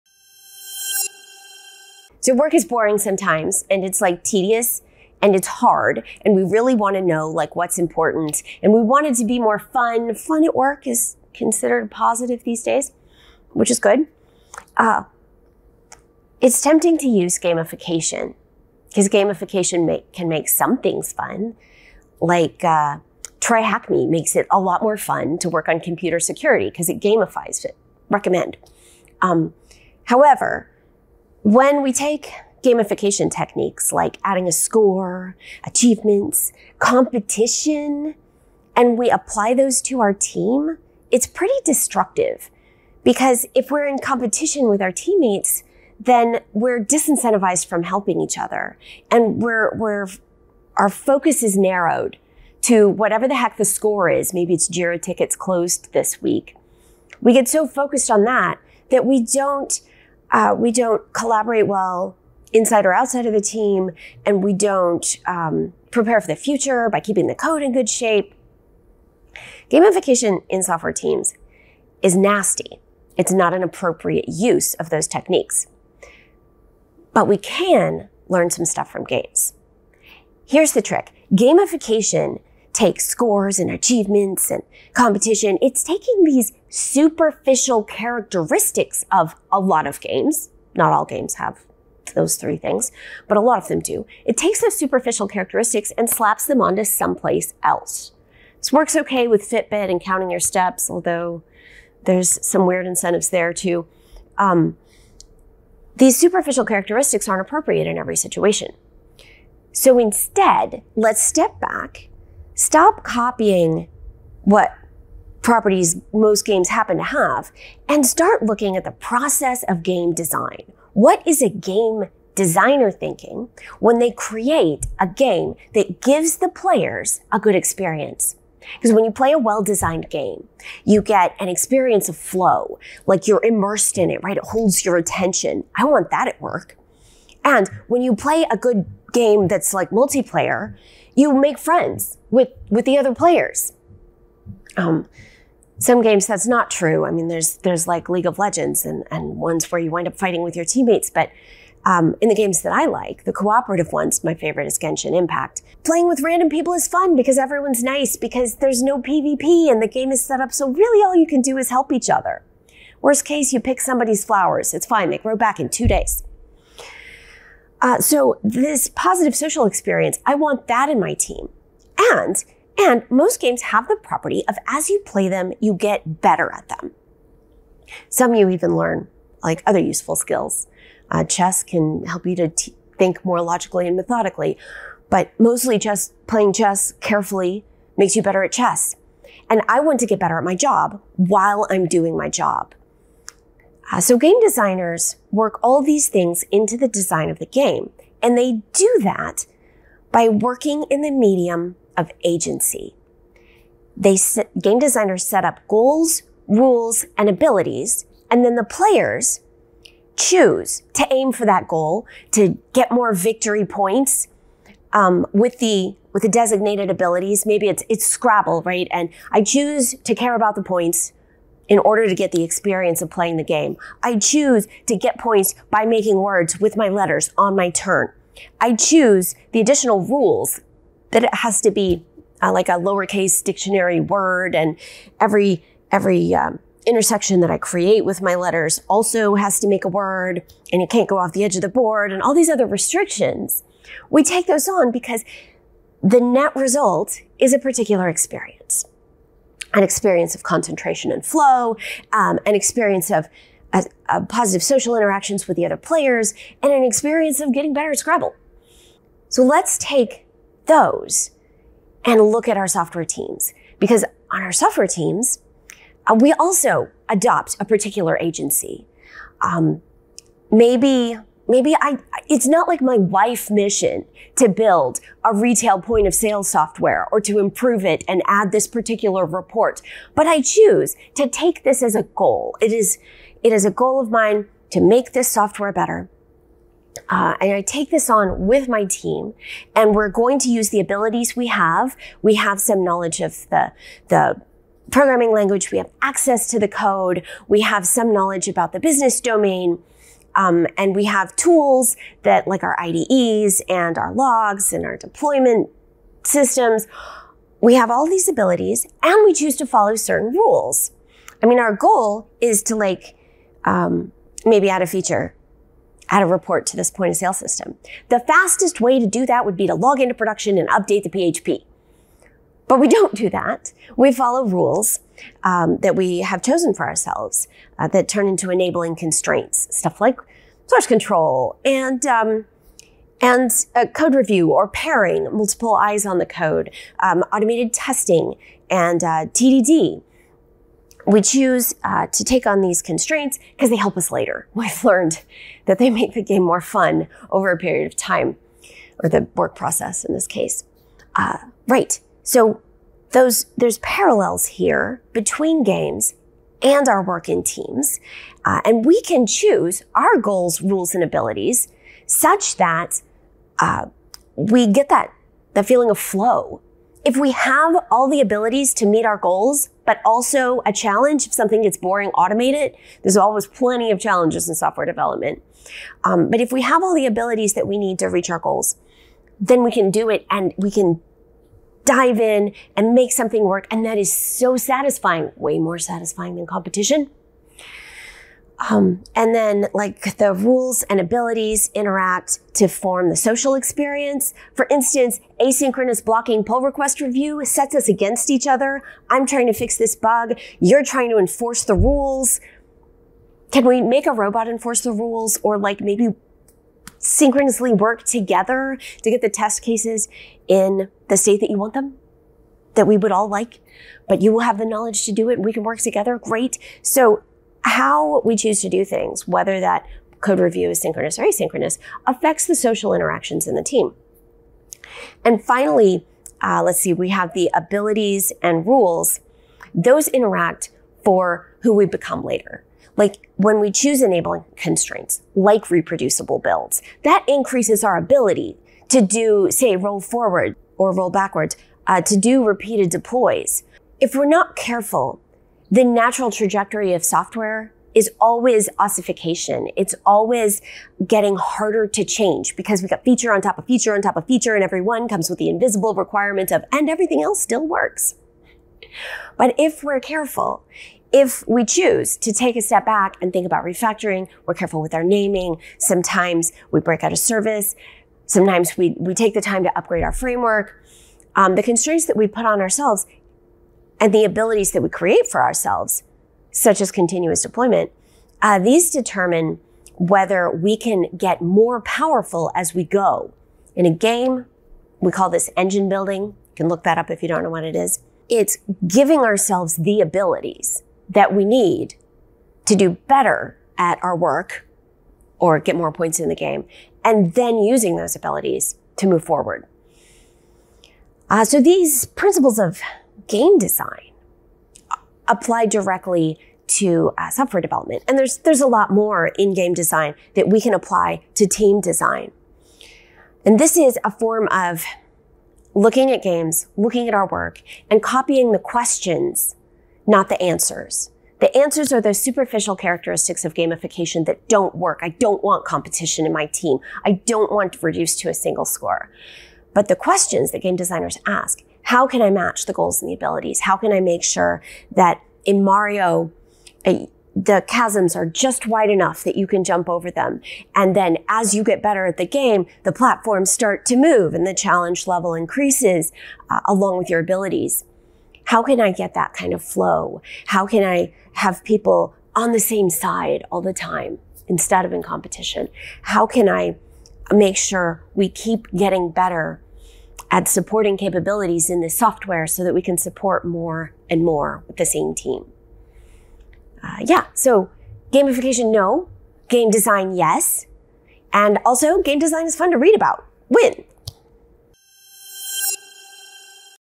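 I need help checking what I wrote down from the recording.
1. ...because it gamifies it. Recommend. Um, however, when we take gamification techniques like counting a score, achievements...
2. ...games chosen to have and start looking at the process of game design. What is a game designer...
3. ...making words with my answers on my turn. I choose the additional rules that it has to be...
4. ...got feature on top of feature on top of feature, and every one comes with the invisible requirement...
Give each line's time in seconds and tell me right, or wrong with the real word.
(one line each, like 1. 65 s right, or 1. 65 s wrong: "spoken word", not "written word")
1. 26 s wrong: "adding", not "counting"
2. 116 s wrong: "happen", not "chosen"
3. 225 s wrong: "letters", not "answers"
4. 452 s right.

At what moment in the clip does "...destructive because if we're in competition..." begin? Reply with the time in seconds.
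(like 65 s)
41 s.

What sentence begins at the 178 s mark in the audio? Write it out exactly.
Some you even learn like other useful skills.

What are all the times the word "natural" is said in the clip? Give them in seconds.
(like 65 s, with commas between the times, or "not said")
445 s.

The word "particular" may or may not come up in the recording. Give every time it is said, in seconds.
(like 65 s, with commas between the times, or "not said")
247 s, 267 s, 278 s.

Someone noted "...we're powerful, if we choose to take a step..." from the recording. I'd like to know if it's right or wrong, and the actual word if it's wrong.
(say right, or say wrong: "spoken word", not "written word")
wrong: "careful", not "powerful".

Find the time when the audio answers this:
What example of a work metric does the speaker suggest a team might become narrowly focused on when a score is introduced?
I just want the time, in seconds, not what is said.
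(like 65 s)
54 s.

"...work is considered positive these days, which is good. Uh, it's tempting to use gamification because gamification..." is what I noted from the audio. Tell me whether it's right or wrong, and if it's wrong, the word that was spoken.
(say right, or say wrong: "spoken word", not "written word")
right.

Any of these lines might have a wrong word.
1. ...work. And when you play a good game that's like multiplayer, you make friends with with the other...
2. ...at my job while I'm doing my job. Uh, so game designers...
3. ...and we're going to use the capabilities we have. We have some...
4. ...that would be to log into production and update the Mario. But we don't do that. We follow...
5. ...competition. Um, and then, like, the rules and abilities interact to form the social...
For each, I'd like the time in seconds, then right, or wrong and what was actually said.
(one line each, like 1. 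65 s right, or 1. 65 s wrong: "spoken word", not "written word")
1. 136 s right
2. 190 s right
3. 289 s wrong: "abilities", not "capabilities"
4. 319 s wrong: "PHP", not "Mario"
5. 386 s right.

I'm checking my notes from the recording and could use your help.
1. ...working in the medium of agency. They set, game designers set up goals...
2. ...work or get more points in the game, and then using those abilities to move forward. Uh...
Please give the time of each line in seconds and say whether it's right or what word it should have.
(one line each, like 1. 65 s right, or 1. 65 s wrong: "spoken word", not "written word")
1. 200 s right
2. 494 s right.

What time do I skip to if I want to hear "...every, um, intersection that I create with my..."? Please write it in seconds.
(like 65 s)
235 s.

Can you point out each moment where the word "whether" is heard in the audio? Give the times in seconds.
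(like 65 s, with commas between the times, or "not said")
419 s, 479 s.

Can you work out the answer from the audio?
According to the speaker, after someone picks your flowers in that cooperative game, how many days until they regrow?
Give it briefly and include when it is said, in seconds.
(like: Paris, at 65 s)
2, at 165 s.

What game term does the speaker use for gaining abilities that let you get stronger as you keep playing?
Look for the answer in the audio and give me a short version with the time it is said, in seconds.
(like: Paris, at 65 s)
Engine building, at 485 s.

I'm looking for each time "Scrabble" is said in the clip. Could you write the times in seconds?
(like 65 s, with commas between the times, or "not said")
218 s, 257 s.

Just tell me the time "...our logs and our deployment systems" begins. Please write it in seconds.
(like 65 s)
303 s.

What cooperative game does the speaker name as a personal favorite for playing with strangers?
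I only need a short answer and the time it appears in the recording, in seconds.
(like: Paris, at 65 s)
Genshin Impact, at 154 s.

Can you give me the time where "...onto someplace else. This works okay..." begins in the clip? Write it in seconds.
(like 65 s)
96 s.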